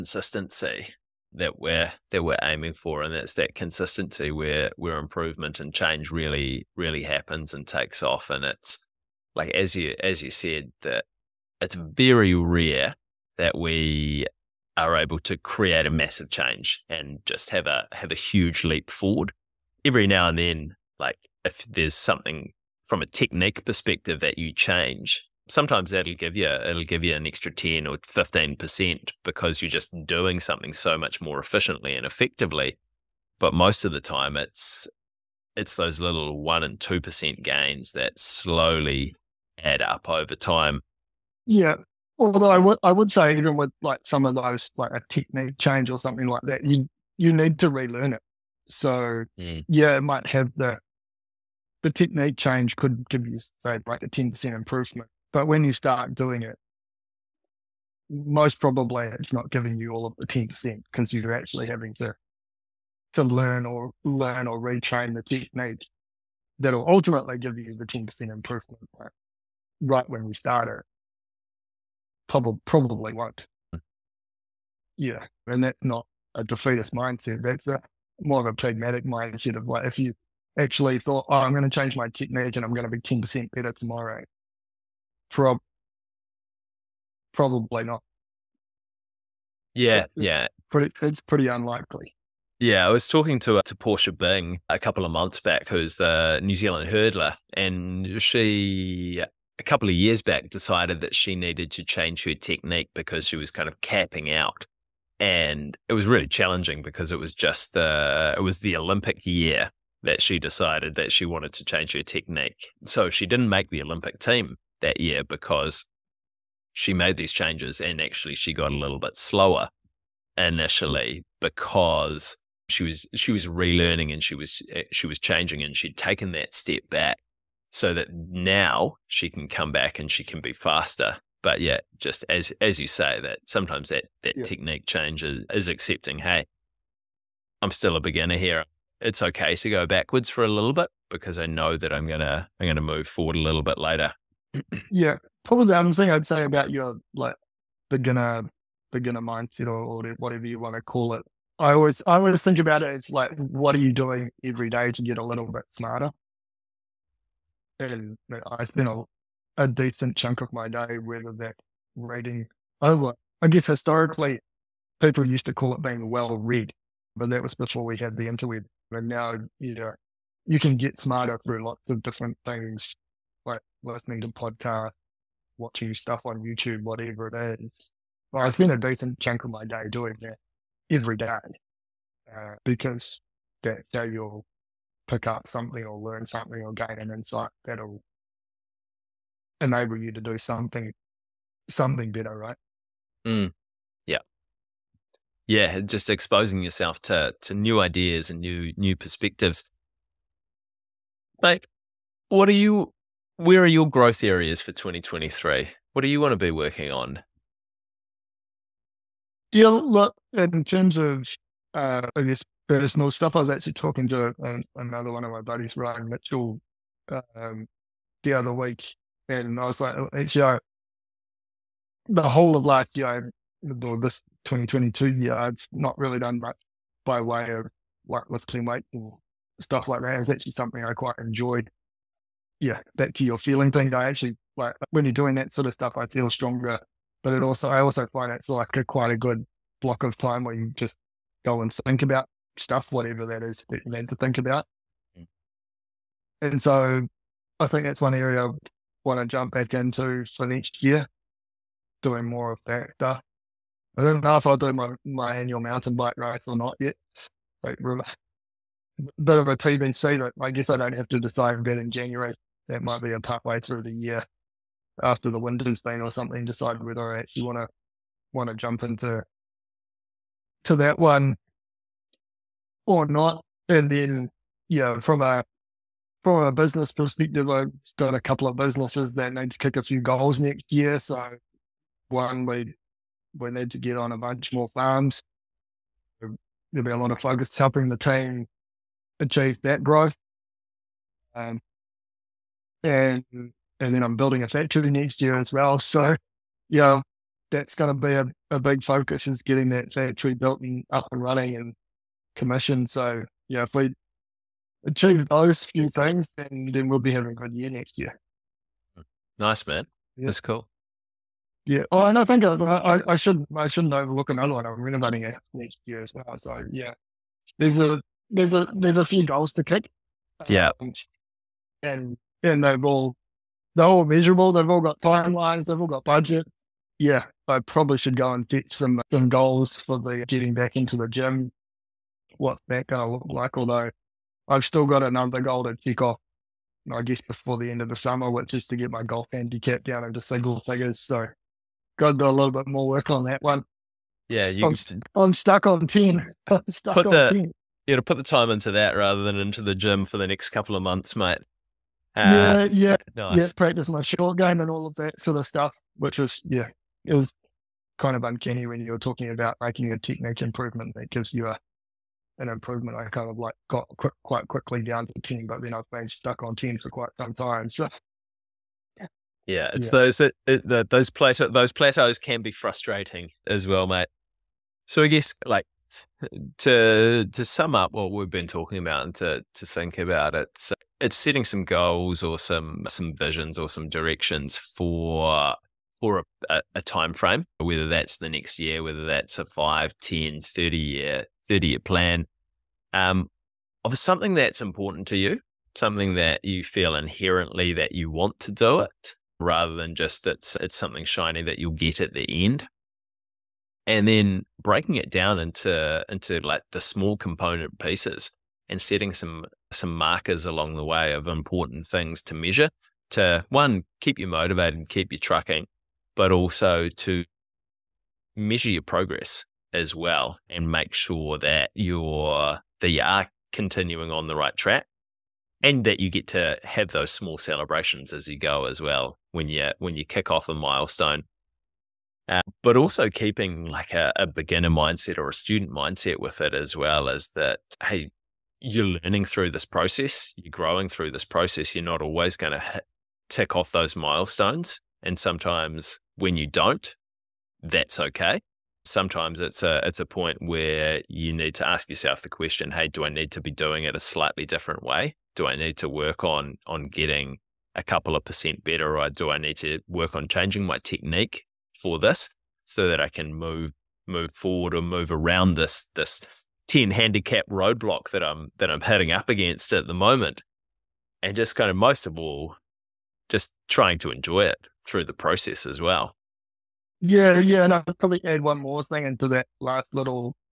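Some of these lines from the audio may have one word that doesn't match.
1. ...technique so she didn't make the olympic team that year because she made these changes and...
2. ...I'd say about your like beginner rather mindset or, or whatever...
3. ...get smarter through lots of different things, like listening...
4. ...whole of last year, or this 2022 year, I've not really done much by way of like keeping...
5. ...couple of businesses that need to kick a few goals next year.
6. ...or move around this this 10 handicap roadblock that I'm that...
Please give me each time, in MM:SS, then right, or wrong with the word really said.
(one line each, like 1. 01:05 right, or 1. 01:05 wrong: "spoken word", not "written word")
1. 01:52 right
2. 02:26 wrong: "beginner", not "rather"
3. 02:50 right
4. 03:42 wrong: "lifting", not "keeping"
5. 04:38 right
6. 07:44 right.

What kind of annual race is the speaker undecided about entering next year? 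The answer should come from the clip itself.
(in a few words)
mountain bike race.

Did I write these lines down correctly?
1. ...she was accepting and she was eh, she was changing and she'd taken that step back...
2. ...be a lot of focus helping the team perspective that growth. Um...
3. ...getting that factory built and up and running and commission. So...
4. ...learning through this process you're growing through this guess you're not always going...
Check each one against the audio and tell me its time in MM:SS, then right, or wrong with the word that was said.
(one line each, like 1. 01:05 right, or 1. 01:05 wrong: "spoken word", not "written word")
1. 02:03 wrong: "relearning", not "accepting"
2. 04:46 wrong: "achieve", not "perspective"
3. 04:59 right
4. 07:19 wrong: "process", not "guess".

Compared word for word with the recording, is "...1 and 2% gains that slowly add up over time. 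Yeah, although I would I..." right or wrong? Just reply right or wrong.
right.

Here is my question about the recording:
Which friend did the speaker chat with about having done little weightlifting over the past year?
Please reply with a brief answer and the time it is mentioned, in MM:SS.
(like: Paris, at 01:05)
Ryan Mitchell, at 03:35.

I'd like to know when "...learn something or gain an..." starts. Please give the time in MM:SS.
03:05.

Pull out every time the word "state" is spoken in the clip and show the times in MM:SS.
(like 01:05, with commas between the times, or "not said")
not said.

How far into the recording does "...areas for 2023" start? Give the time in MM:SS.
03:24.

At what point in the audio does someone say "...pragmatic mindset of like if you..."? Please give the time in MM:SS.
01:18.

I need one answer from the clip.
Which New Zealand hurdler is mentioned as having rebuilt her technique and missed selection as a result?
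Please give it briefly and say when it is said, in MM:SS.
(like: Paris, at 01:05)
Portia Bing, at 01:33.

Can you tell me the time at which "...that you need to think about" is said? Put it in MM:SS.
04:03.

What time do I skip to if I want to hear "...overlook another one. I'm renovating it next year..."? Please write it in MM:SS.
05:13.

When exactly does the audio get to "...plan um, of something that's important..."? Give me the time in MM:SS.
06:31.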